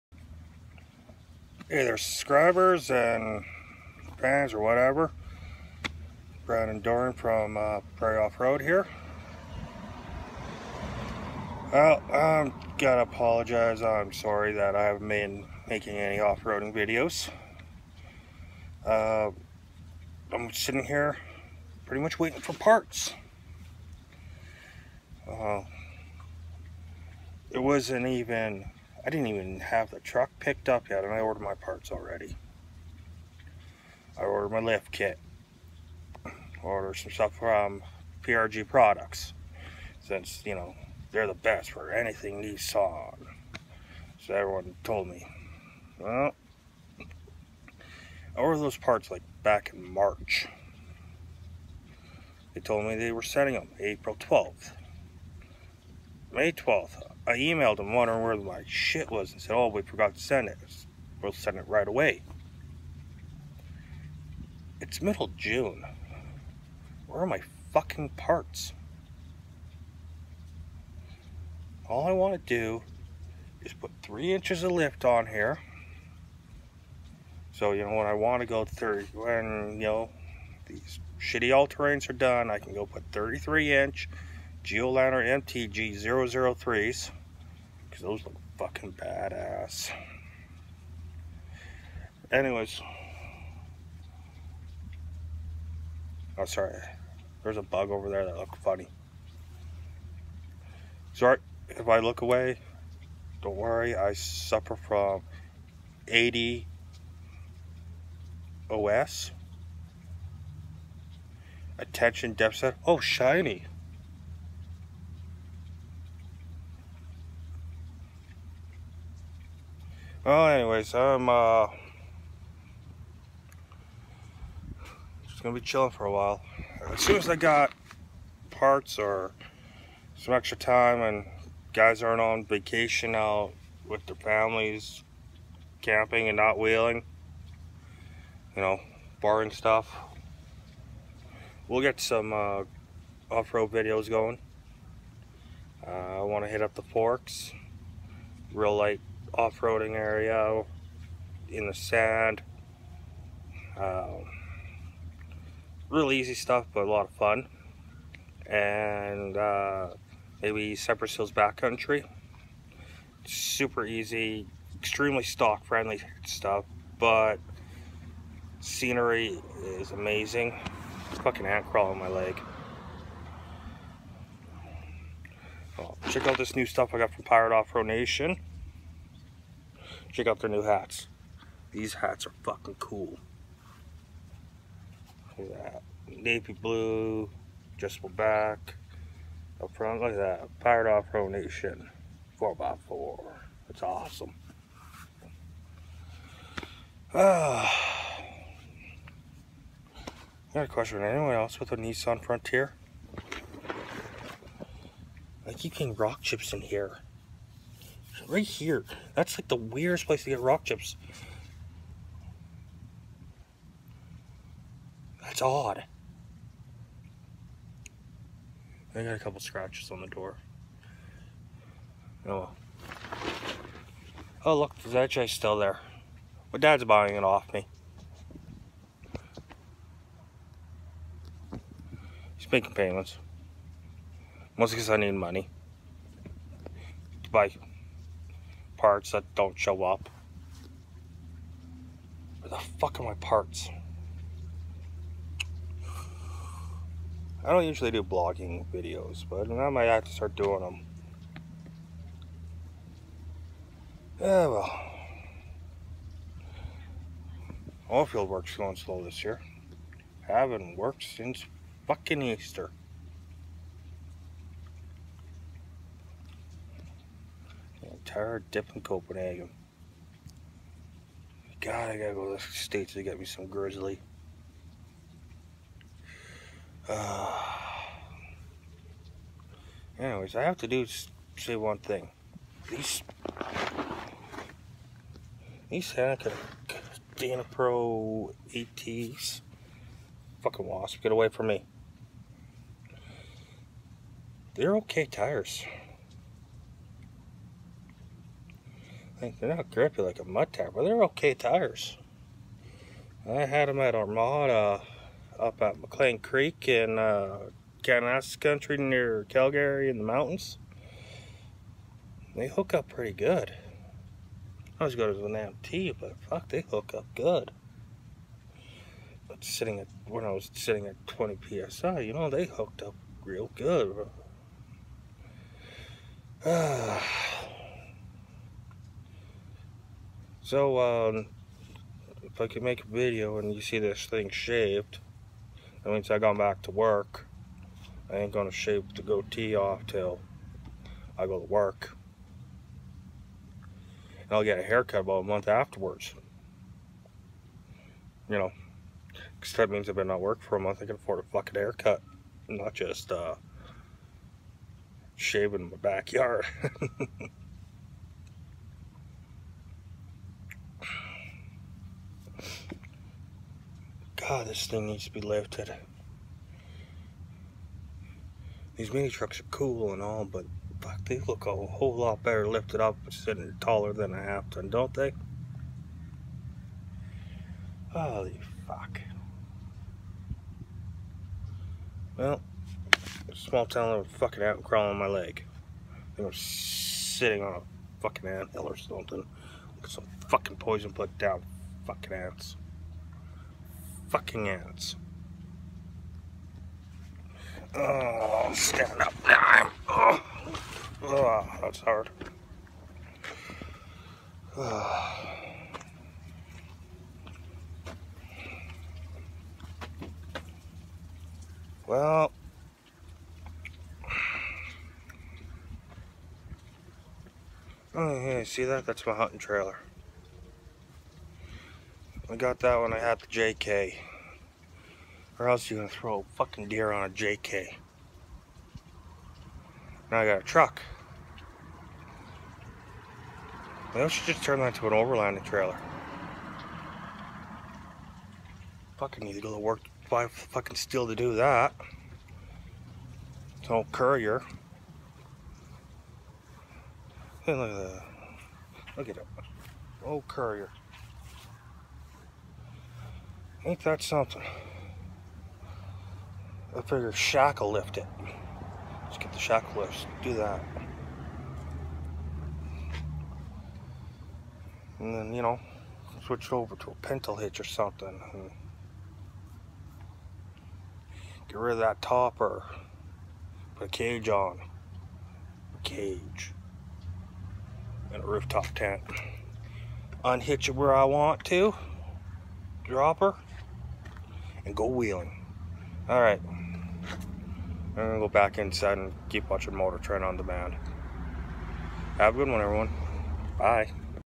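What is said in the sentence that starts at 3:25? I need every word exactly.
I keep getting rock chips in here right here.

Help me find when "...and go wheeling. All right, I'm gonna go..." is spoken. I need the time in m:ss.
8:04.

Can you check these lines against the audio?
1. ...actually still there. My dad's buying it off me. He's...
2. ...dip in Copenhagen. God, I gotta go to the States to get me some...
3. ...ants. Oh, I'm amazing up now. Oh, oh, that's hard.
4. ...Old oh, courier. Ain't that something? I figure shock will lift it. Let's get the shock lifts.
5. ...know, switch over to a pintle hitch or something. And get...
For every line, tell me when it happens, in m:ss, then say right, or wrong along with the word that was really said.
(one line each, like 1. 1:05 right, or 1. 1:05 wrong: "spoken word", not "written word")
1. 3:44 right
2. 4:28 right
3. 6:34 wrong: "standing", not "amazing"
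4. 7:30 right
5. 7:45 right.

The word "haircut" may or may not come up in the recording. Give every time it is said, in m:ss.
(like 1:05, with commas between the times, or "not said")
5:44, 5:51.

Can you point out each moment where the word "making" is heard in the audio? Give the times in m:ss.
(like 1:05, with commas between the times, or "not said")
0:15, 3:52.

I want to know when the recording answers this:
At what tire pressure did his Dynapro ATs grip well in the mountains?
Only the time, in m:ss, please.
5:21.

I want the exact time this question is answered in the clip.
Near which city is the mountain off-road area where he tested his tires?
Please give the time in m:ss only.
5:09.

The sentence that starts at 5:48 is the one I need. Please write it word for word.
You know, because that means I've been not work for a month.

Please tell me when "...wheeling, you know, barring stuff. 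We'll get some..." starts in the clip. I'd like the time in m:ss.
2:16.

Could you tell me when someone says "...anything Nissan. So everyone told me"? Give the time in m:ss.
0:41.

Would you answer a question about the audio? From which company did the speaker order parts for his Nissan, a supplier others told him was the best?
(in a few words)
PRG Products.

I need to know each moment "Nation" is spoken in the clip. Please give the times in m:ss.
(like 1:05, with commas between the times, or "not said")
2:57, 3:11.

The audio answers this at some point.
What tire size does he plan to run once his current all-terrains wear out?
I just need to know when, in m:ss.
1:23.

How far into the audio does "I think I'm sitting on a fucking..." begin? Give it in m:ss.
6:25.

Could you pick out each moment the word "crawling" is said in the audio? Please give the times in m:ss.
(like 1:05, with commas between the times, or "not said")
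2:51, 6:24.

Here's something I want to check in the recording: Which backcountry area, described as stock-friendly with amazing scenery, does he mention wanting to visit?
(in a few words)
Cypress Hills.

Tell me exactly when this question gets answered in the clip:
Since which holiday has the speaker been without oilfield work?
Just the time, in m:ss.
4:22.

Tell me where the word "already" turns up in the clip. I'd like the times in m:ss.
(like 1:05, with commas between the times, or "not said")
0:31.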